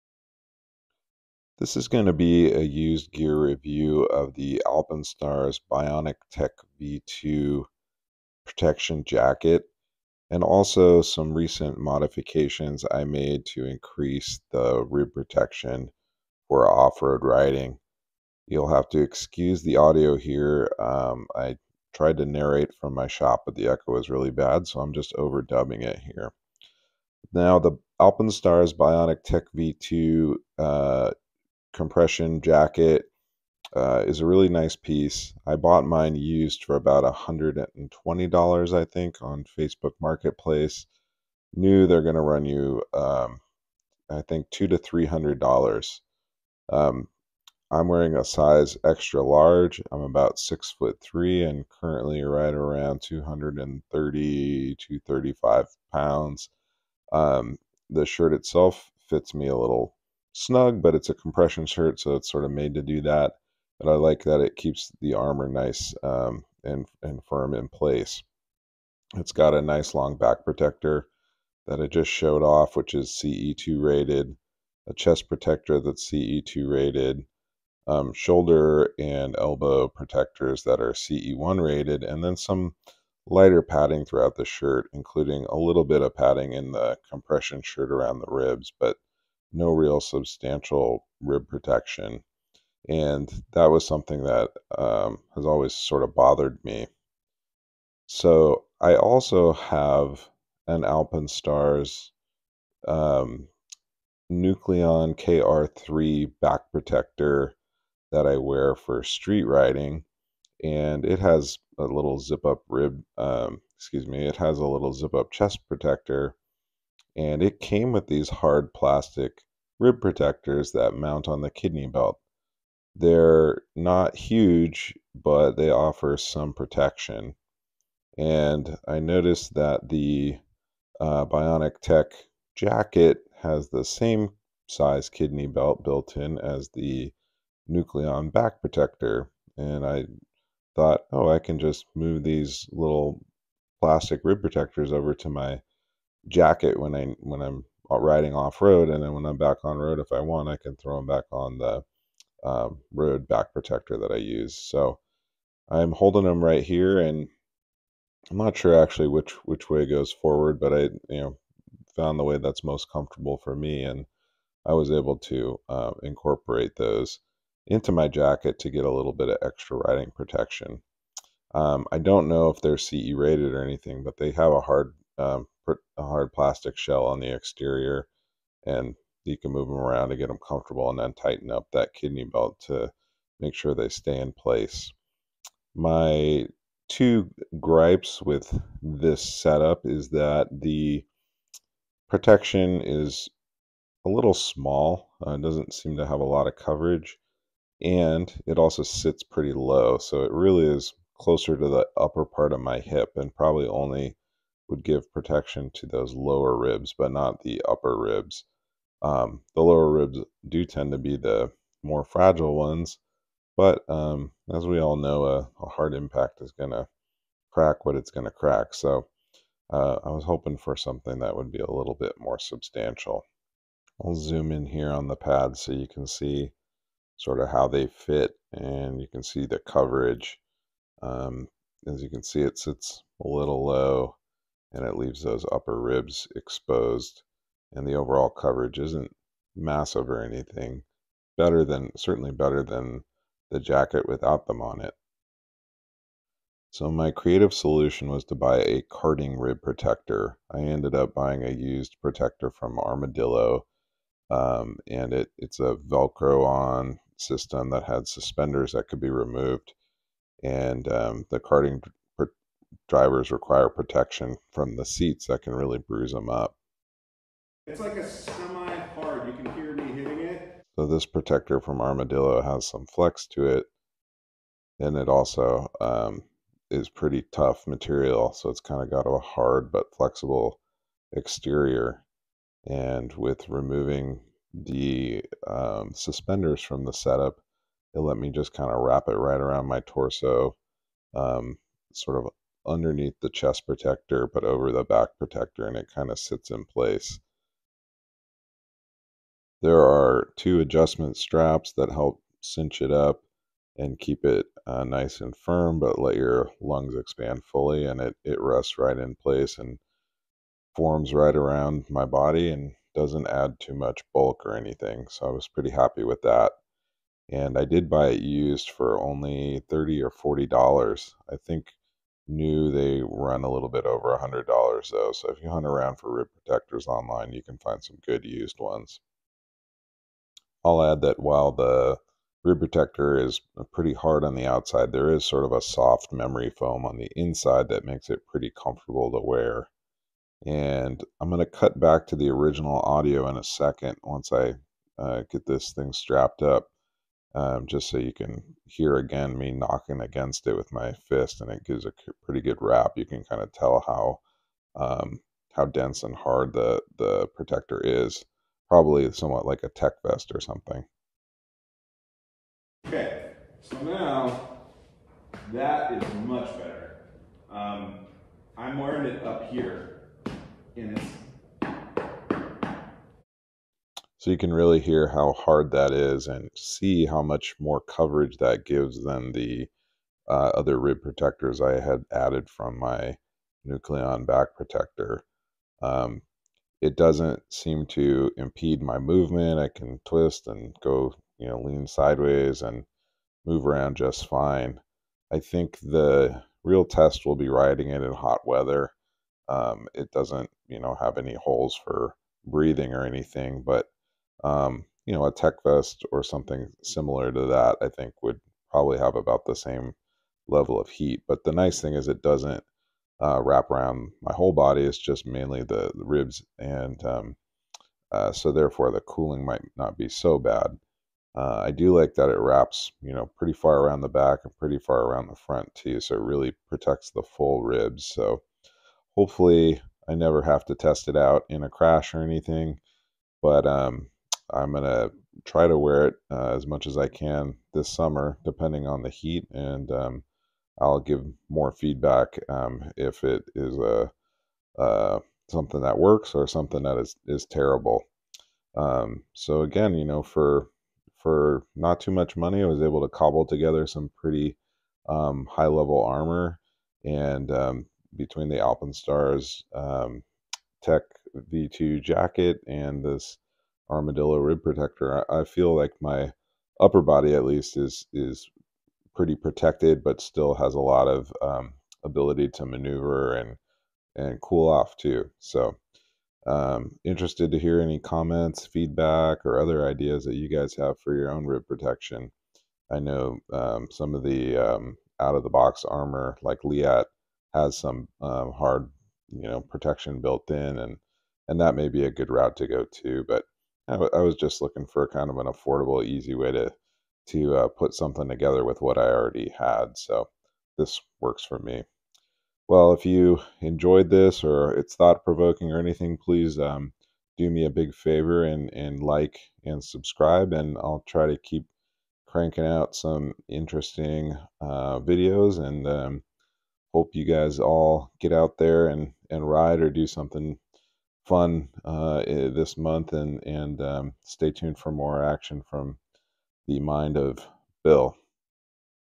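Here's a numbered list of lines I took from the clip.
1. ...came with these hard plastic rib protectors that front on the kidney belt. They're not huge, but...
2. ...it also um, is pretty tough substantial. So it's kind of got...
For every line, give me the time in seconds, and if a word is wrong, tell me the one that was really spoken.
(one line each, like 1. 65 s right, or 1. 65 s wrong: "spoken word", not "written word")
1. 117 s wrong: "mount", not "front"
2. 274 s wrong: "material", not "substantial".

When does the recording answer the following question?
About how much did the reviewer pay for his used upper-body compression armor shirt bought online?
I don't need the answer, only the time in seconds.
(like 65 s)
37 s.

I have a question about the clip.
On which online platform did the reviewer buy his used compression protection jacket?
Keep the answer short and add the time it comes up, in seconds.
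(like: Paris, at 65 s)
Facebook Marketplace, at 39 s.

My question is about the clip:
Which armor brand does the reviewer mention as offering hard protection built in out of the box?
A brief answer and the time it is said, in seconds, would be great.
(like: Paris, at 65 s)
Leatt, at 486 s.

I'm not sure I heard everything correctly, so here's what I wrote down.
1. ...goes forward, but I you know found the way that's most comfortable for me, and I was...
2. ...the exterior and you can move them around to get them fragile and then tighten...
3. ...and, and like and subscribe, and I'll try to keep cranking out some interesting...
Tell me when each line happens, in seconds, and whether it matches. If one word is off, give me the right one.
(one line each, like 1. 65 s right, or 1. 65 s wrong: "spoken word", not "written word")
1. 159 s right
2. 177 s wrong: "comfortable", not "fragile"
3. 508 s right.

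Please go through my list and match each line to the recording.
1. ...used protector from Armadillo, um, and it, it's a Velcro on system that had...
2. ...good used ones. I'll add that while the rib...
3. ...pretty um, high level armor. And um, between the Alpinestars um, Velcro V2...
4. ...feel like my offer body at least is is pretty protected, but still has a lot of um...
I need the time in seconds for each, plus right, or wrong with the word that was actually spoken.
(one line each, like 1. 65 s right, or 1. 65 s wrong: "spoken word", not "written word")
1. 251 s right
2. 328 s right
3. 454 s wrong: "Tech", not "Velcro"
4. 465 s wrong: "upper", not "offer".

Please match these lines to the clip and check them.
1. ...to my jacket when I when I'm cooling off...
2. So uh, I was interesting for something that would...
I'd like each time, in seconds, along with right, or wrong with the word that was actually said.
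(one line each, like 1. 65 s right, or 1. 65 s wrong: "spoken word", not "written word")
1. 145 s wrong: "riding", not "cooling"
2. 218 s wrong: "hoping", not "interesting".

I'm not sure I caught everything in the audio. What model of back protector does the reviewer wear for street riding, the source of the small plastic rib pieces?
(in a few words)
Nucleon KR3.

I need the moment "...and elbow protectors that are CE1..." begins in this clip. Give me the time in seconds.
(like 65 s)
78 s.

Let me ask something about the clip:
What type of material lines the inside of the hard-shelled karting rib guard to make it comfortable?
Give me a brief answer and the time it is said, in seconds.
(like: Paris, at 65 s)
memory foam, at 336 s.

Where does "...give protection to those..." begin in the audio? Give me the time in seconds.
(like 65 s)
204 s.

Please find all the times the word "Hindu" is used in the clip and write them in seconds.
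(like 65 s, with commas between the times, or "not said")
not said.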